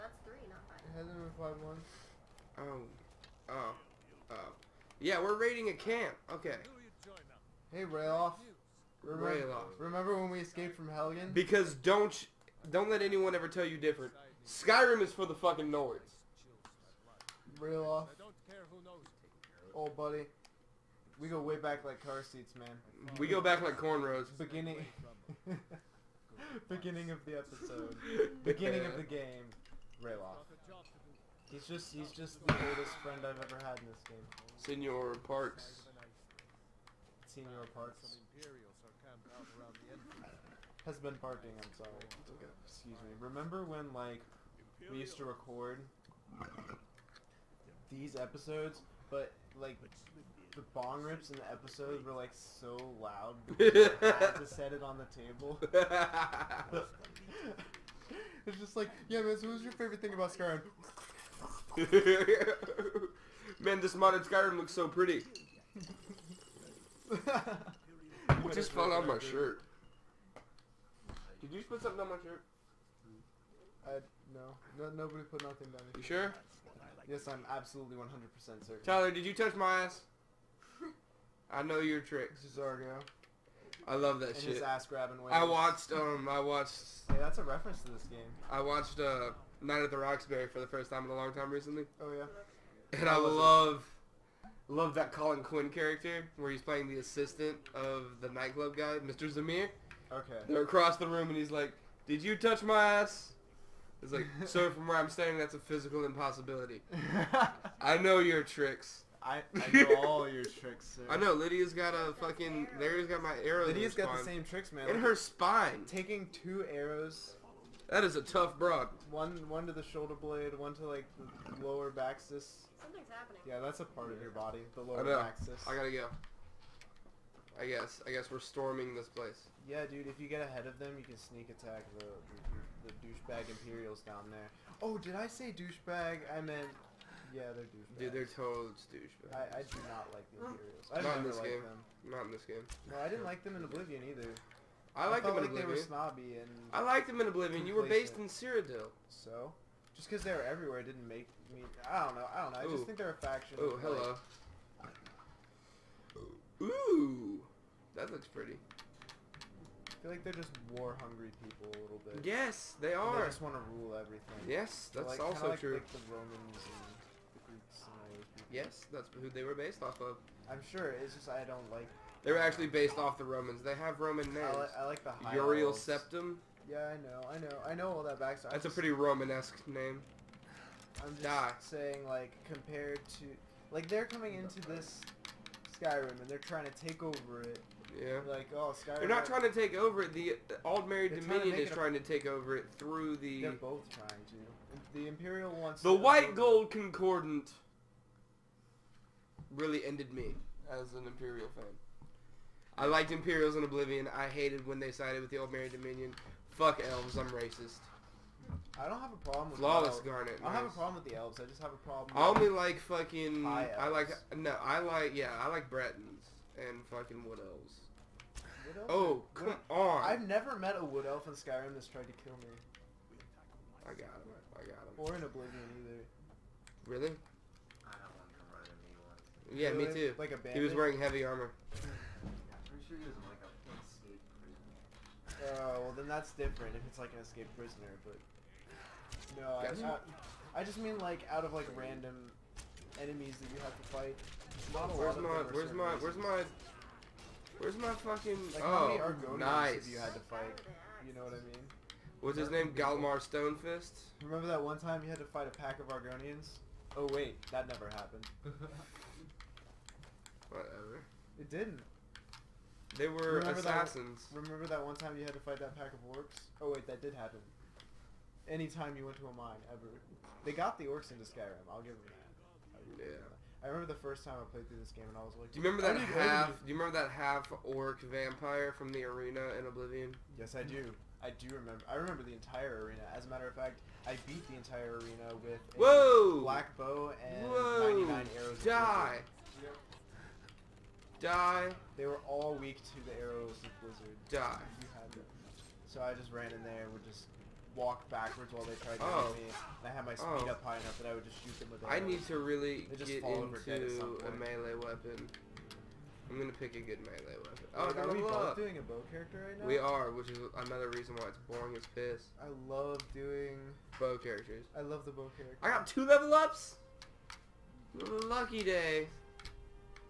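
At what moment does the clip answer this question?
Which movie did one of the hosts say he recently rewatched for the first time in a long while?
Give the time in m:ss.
1:29.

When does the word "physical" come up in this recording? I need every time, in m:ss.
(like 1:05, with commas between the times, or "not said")
1:45.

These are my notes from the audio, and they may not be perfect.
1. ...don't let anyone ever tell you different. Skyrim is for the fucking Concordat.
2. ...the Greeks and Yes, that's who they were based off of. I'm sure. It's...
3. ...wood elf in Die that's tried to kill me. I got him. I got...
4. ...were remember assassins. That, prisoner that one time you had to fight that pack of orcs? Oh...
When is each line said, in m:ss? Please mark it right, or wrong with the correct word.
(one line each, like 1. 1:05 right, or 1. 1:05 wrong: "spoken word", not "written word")
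1. 0:12 wrong: "Nords", not "Concordat"
2. 2:47 right
3. 3:40 wrong: "Skyrim", not "Die"
4. 4:23 wrong: "remember", not "prisoner".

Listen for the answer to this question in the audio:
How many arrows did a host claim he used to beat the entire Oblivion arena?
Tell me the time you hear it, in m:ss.
4:48.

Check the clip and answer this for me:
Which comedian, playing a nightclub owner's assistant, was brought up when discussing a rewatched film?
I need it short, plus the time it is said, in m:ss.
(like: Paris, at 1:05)
Colin Quinn, at 1:35.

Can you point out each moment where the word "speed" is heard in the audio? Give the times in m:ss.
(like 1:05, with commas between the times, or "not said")
5:00.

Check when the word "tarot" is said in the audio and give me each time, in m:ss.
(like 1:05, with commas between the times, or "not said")
not said.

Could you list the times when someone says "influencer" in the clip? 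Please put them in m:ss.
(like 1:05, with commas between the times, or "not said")
not said.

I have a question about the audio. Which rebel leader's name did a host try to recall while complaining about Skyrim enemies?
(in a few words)
Galmar Stonefist.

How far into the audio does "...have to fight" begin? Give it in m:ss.
4:03.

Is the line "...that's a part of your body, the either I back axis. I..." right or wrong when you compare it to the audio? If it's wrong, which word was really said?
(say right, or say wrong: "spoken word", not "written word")
wrong: "lower", not "either".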